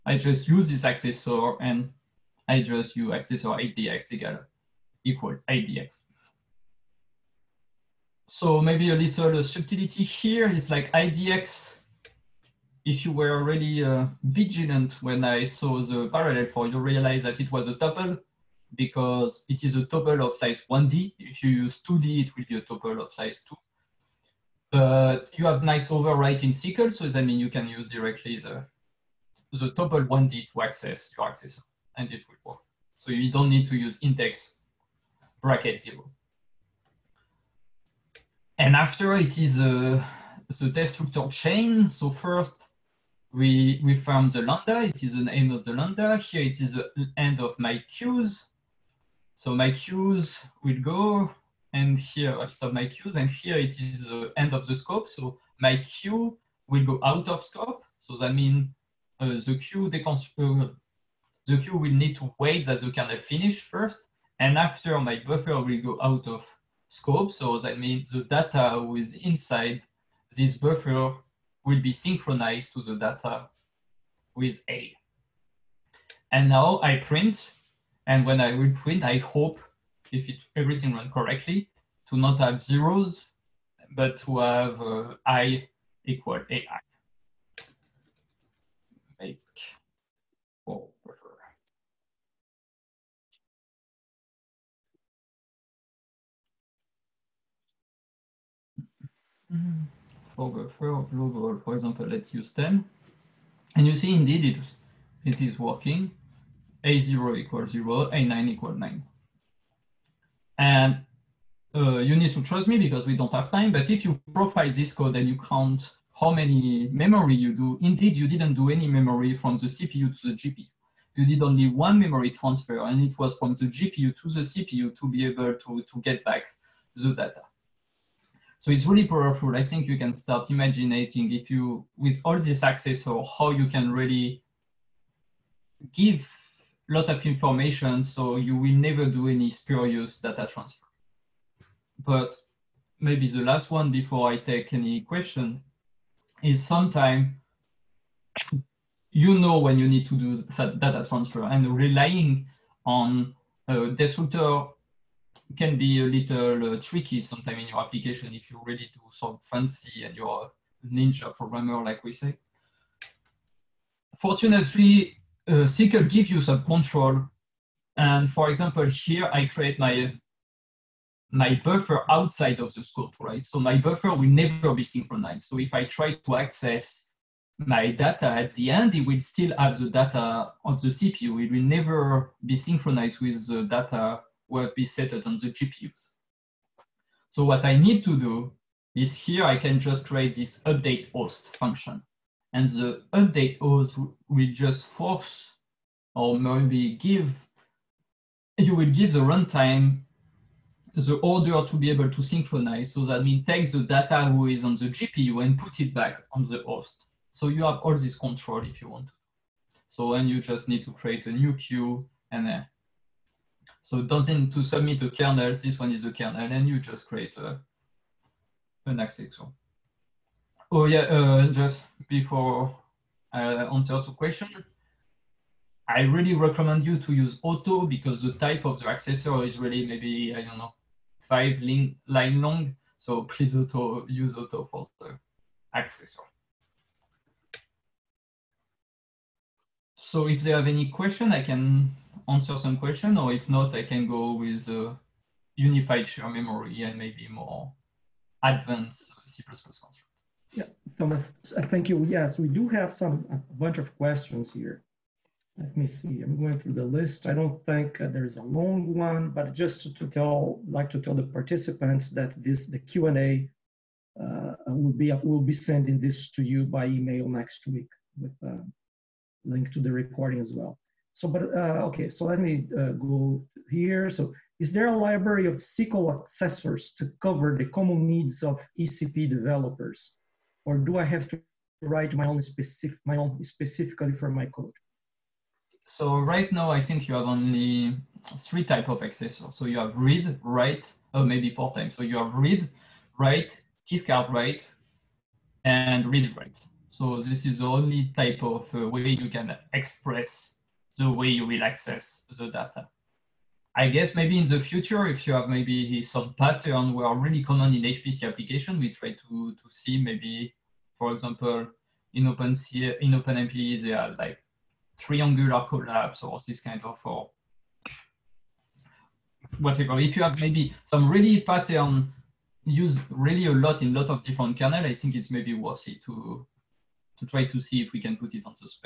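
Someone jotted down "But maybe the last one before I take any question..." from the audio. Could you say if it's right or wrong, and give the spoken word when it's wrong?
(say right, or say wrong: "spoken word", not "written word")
right.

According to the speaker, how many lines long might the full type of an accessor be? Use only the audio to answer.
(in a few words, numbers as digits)
5.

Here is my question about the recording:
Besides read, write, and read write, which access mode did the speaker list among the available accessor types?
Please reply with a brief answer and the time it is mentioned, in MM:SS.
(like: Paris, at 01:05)
discard write, at 04:53.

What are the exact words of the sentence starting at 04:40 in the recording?
or do I have to write my own specific, my own specifically for my code?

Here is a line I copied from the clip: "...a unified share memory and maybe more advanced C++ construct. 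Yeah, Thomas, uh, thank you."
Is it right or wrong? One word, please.
right.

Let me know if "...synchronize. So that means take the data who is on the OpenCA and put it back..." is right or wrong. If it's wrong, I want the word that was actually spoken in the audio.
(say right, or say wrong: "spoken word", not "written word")
wrong: "GPU", not "OpenCA".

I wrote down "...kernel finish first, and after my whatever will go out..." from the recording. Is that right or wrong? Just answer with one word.
wrong.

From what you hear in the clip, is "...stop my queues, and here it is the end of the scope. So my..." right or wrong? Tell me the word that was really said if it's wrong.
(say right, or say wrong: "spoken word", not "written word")
right.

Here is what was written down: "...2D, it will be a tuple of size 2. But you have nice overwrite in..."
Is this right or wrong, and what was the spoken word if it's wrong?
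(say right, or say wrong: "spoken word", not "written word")
right.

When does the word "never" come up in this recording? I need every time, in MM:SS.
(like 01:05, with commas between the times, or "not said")
02:18, 02:54, 03:01.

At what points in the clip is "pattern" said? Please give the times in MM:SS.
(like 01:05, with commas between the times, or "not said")
05:06, 05:21.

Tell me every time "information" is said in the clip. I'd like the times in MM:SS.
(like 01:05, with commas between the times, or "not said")
02:17.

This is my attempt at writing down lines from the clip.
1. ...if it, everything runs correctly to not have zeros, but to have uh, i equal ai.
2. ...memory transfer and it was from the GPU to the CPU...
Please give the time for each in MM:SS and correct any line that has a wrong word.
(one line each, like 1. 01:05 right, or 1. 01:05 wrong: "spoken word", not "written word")
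1. 01:20 right
2. 02:01 right.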